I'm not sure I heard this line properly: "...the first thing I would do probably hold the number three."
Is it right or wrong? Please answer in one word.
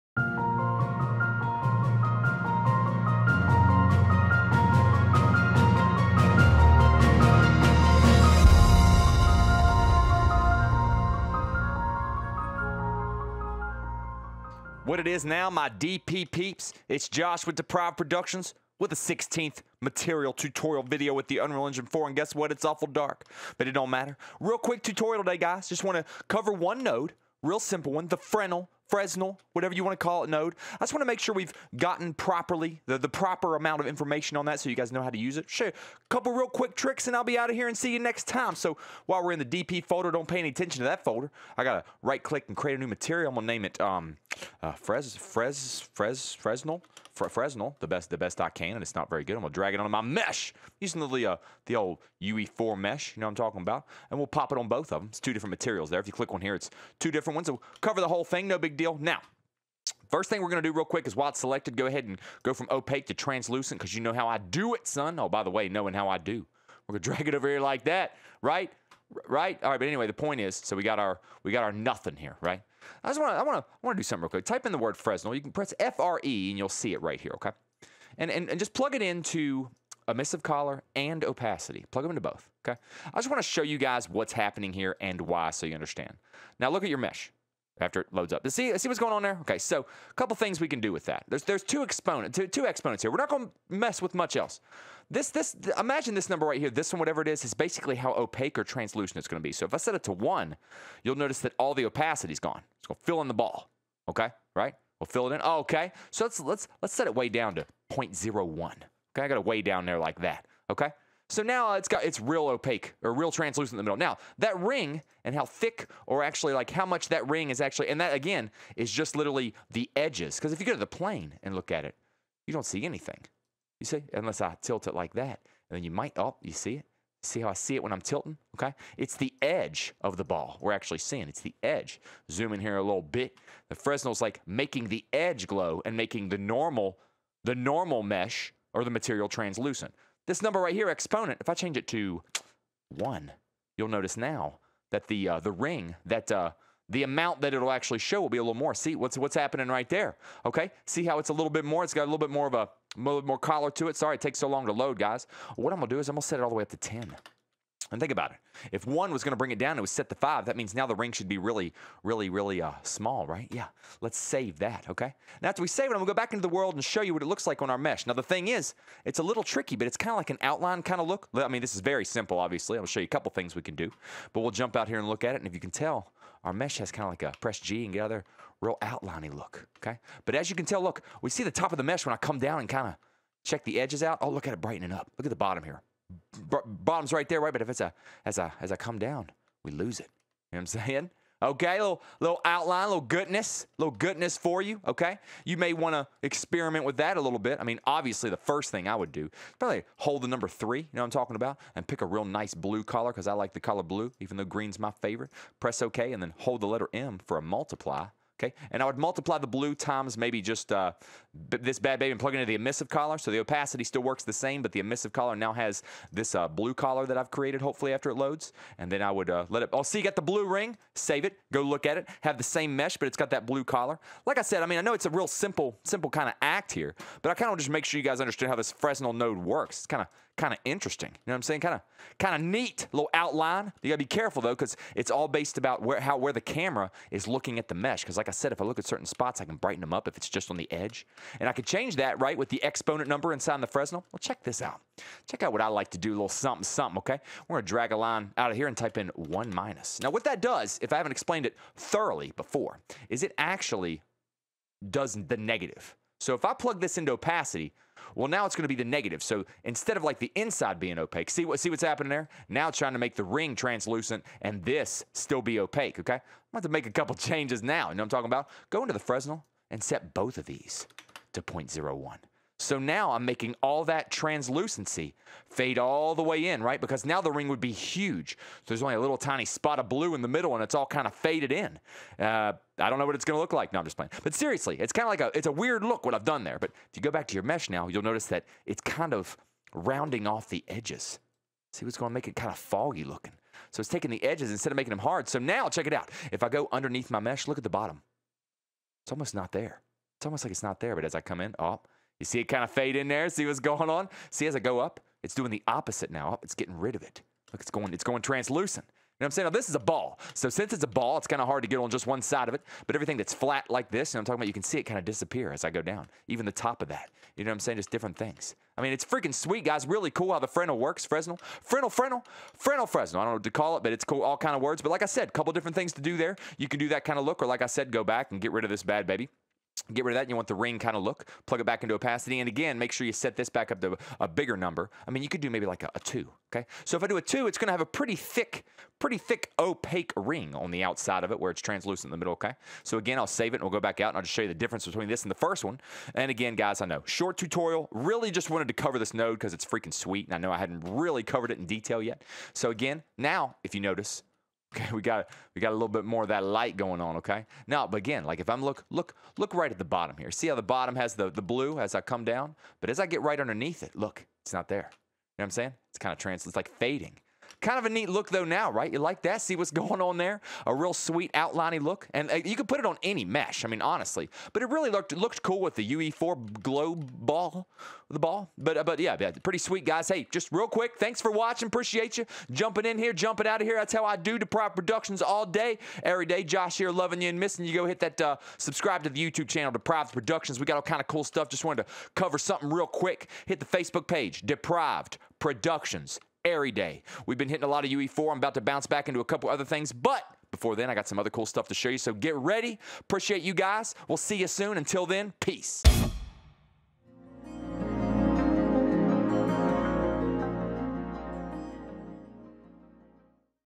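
right.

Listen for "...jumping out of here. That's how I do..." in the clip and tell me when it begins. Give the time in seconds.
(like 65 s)
383 s.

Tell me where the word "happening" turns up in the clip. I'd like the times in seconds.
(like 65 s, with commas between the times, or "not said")
84 s, 149 s, 261 s.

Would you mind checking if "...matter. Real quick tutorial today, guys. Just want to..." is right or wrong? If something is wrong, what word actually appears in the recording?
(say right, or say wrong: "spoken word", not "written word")
right.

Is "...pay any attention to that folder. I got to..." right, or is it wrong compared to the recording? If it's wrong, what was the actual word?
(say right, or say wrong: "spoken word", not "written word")
right.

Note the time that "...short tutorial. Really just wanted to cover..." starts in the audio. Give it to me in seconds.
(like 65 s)
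347 s.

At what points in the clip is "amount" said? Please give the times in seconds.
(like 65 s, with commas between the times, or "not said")
33 s, 147 s.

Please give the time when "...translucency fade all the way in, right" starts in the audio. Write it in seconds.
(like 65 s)
274 s.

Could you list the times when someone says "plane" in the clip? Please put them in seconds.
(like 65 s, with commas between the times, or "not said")
120 s.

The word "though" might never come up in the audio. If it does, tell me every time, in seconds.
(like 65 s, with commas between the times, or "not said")
204 s, 234 s, 368 s.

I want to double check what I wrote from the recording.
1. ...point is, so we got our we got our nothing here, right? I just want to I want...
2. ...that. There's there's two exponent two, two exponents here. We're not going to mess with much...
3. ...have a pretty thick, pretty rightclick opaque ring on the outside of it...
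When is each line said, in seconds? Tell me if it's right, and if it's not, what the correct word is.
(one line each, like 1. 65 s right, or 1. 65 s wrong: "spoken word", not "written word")
1. 70 s right
2. 91 s right
3. 337 s wrong: "thick", not "rightclick".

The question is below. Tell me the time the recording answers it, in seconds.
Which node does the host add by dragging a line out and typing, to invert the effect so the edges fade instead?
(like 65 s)
249 s.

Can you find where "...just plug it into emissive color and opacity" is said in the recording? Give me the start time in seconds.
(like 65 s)
78 s.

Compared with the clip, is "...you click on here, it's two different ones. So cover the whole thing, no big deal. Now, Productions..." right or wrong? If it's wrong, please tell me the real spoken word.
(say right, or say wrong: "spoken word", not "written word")
wrong: "First", not "Productions".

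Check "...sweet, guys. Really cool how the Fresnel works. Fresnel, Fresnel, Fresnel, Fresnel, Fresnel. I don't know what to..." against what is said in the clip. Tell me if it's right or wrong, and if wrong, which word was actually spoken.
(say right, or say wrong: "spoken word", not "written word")
right.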